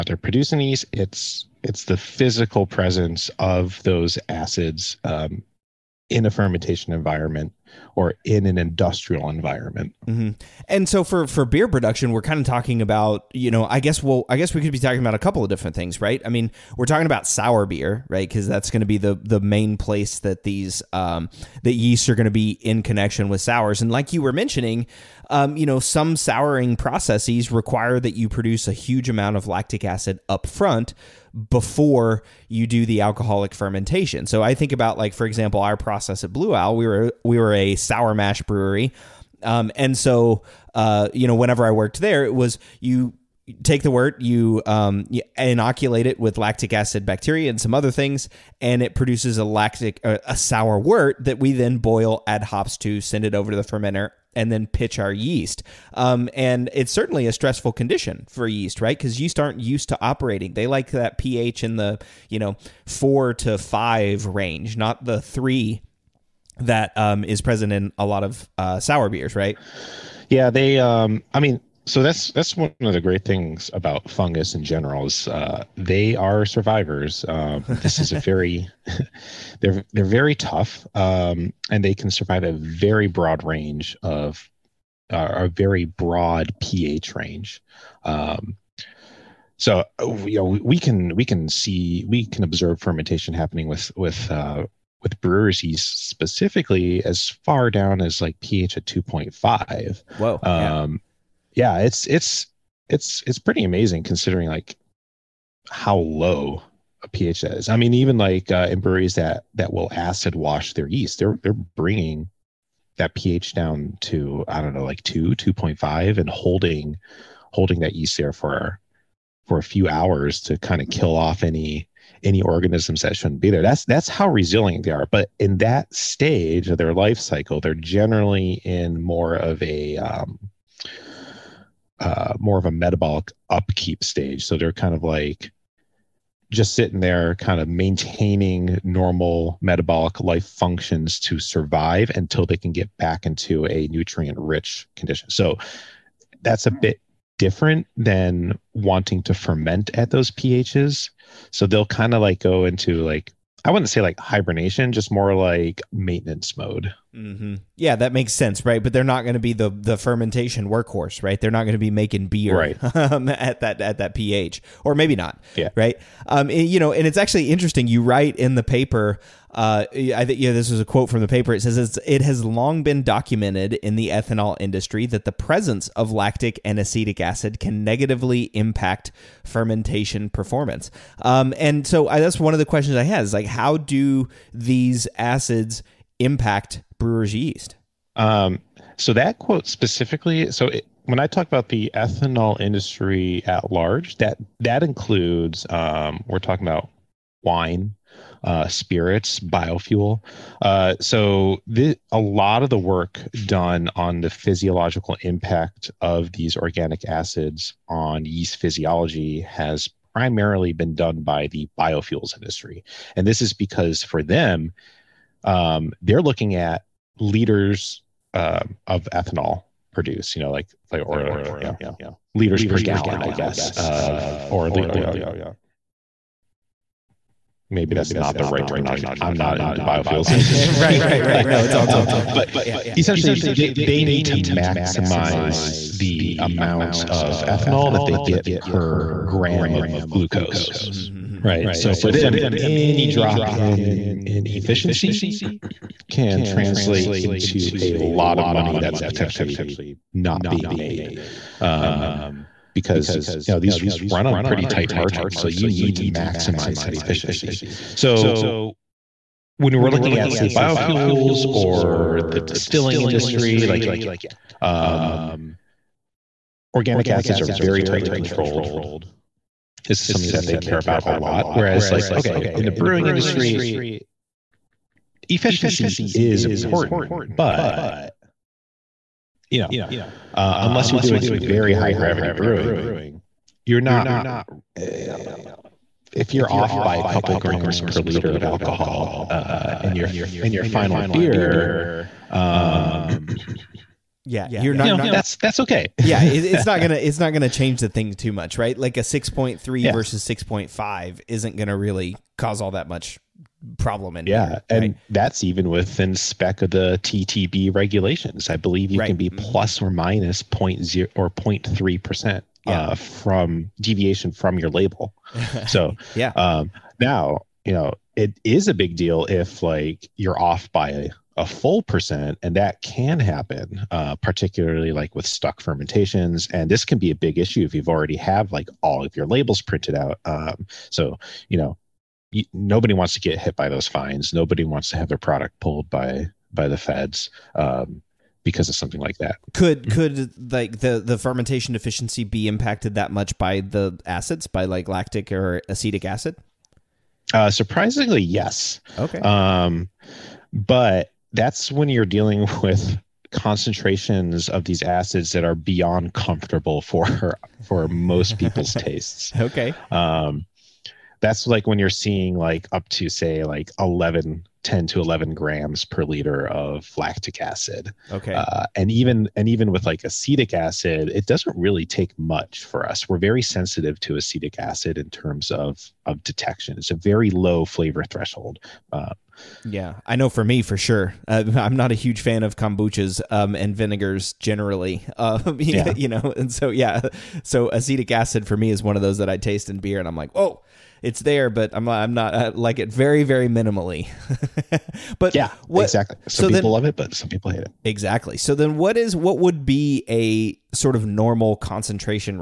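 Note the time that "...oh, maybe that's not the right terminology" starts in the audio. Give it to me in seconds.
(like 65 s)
225 s.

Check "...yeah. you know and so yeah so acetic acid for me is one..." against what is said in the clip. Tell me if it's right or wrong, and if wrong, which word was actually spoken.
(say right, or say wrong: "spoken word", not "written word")
right.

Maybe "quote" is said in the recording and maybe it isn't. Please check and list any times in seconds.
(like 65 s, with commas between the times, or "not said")
170 s, 189 s.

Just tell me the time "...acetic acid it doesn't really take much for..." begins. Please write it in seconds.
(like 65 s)
370 s.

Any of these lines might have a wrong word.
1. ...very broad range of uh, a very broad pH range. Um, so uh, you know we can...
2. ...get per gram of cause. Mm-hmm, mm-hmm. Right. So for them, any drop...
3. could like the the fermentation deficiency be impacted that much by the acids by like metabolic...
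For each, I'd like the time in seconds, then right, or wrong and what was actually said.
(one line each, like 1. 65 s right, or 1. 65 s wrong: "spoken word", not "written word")
1. 82 s right
2. 238 s wrong: "glucose", not "cause"
3. 339 s wrong: "lactic", not "metabolic".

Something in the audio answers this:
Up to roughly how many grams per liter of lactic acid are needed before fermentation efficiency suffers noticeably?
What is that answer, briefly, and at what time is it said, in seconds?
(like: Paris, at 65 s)
10 to 11 grams per liter, at 364 s.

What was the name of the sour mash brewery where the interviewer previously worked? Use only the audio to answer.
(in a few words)
Blue Owl.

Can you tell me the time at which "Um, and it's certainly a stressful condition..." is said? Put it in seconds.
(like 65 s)
55 s.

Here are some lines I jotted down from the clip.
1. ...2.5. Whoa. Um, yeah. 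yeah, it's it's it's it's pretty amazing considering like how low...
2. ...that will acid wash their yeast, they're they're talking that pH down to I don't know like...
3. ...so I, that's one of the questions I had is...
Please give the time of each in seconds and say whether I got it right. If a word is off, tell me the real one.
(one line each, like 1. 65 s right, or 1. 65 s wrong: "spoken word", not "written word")
1. 98 s right
2. 109 s wrong: "bringing", not "talking"
3. 181 s right.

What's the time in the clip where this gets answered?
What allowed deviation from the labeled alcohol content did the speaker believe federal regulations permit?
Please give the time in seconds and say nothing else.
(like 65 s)
311 s.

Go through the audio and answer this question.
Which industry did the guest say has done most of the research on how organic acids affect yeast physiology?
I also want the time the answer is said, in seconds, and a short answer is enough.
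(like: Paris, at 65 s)
biofuels industry, at 211 s.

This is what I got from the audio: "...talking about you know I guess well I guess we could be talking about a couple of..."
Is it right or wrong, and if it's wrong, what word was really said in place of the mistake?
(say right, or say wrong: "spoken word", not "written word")
right.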